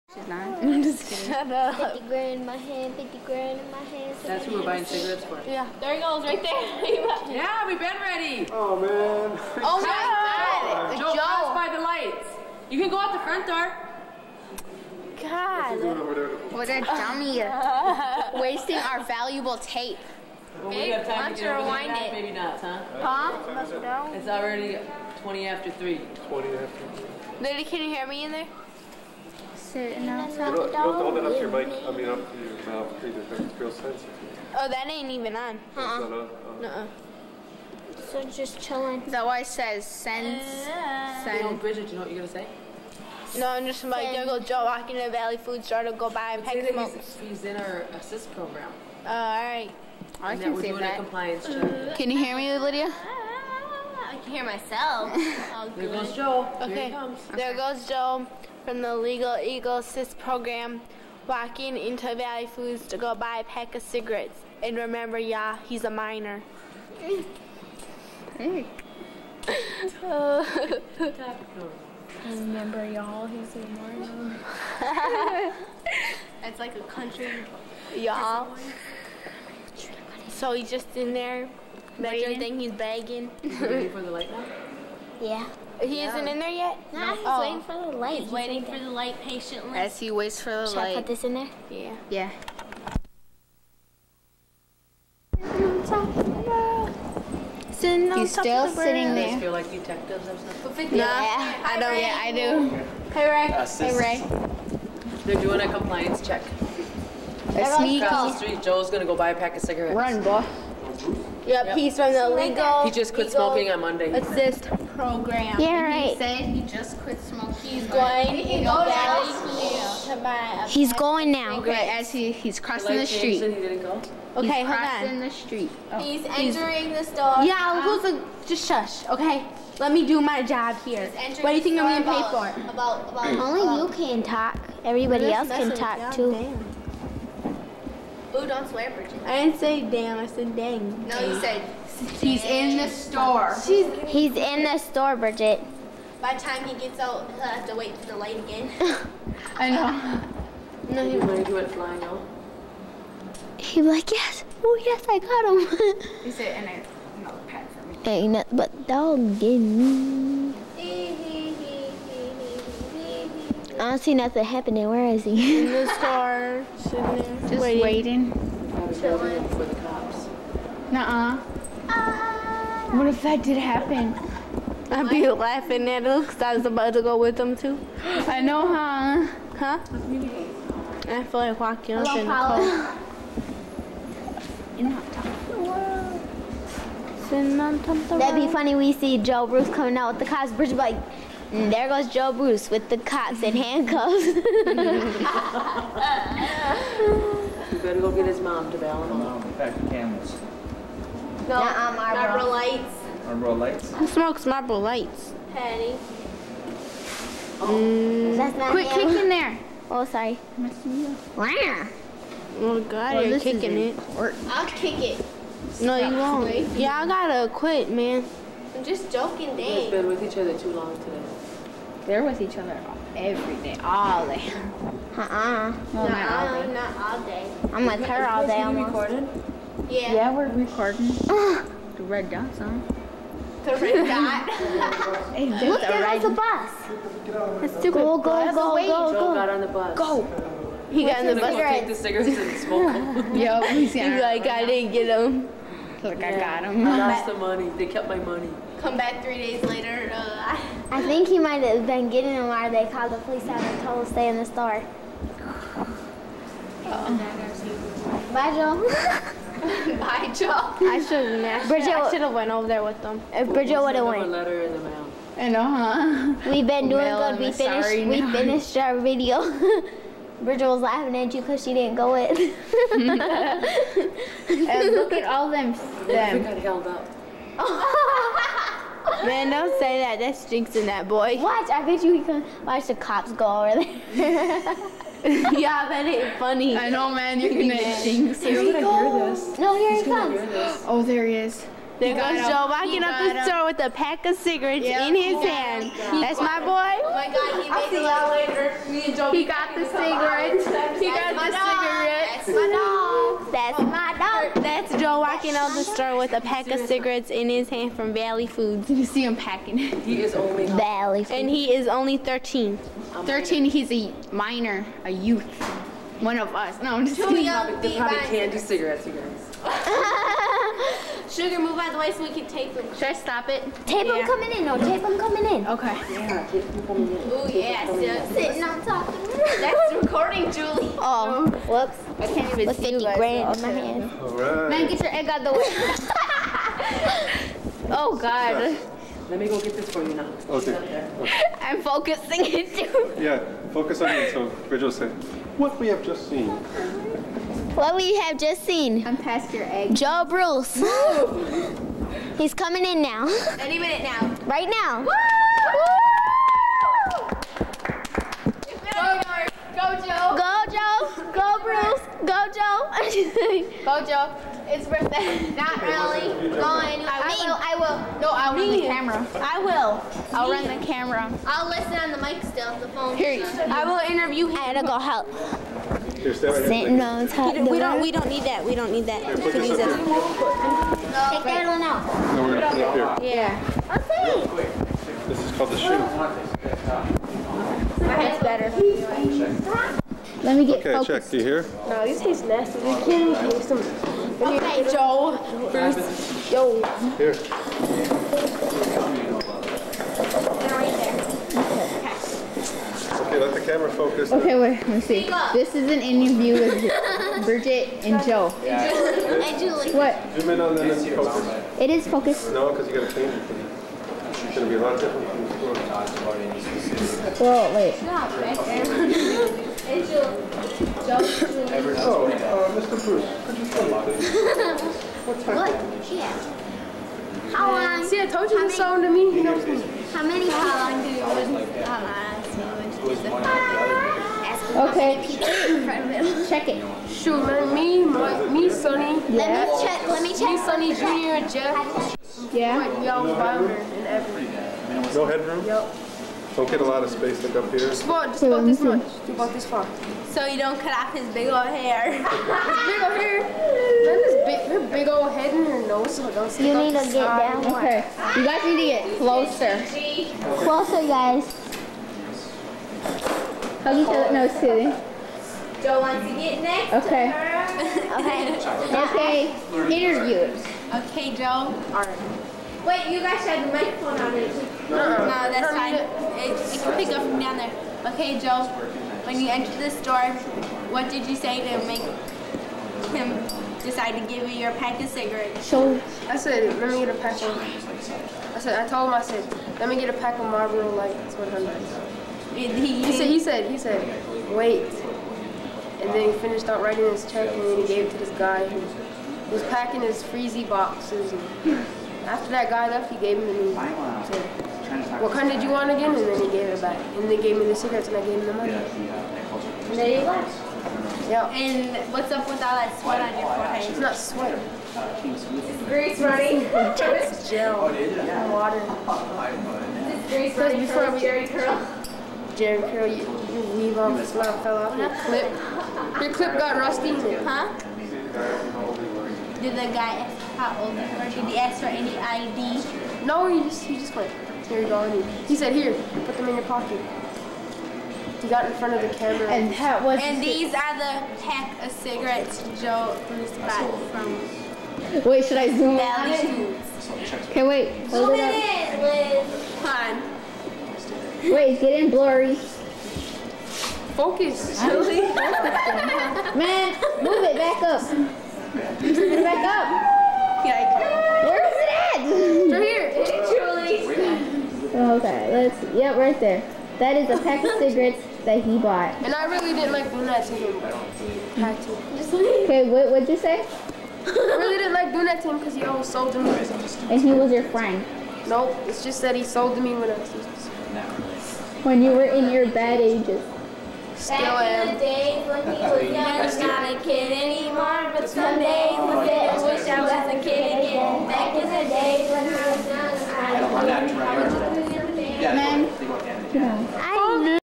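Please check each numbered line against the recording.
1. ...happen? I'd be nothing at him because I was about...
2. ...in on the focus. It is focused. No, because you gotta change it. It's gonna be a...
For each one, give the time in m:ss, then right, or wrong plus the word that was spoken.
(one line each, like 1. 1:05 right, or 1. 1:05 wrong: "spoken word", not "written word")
1. 2:53 wrong: "laughing", not "nothing"
2. 6:50 right.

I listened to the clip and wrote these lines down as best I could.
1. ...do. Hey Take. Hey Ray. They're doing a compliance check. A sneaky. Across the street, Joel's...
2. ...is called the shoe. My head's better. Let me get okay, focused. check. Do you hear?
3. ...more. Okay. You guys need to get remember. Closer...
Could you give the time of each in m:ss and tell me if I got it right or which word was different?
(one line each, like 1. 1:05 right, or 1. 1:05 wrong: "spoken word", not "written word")
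1. 1:42 wrong: "Ray", not "Take"
2. 6:25 right
3. 7:37 wrong: "closer", not "remember".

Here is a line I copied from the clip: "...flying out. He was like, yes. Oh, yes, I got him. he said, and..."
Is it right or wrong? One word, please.
right.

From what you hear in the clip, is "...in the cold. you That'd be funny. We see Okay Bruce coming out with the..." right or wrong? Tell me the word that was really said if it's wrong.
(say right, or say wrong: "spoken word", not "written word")
wrong: "Joe", not "Okay".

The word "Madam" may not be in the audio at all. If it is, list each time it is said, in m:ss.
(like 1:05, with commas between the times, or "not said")
not said.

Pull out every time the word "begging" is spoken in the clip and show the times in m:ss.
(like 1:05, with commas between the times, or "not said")
1:22.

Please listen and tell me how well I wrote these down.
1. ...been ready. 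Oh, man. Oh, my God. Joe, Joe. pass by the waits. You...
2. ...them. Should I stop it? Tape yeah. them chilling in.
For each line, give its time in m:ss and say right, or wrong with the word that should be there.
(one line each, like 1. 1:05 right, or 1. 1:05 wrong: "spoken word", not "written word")
1. 0:07 wrong: "lights", not "waits"
2. 5:22 wrong: "coming", not "chilling".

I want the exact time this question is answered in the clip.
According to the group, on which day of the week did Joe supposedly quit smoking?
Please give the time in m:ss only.
1:53.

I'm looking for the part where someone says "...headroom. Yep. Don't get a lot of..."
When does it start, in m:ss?
7:25.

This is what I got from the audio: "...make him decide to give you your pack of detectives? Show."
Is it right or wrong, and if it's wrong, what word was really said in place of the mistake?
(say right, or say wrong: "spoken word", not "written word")
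wrong: "cigarettes", not "detectives".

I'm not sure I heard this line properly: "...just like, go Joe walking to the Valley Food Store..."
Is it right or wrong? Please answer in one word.
right.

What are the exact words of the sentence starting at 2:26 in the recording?
By the time he gets out, he'll have to wait for the light again.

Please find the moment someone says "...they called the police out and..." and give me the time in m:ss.
4:12.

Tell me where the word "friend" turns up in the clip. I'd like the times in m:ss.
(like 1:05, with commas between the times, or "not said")
9:37.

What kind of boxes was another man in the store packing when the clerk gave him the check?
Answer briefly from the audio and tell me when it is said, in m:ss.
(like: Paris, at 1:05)
Freezy boxes, at 8:20.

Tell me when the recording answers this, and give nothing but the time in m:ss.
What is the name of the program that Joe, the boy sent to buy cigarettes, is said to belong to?
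0:58.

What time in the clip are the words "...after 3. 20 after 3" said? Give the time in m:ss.
0:25.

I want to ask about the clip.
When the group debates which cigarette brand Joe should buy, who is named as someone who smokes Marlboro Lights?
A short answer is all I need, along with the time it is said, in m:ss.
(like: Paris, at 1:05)
Patty, at 3:25.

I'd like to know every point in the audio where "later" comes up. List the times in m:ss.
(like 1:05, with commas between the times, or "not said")
4:09, 4:59.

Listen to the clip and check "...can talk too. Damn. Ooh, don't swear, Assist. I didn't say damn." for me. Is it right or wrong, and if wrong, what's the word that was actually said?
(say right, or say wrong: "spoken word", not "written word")
wrong: "Bridget", not "Assist".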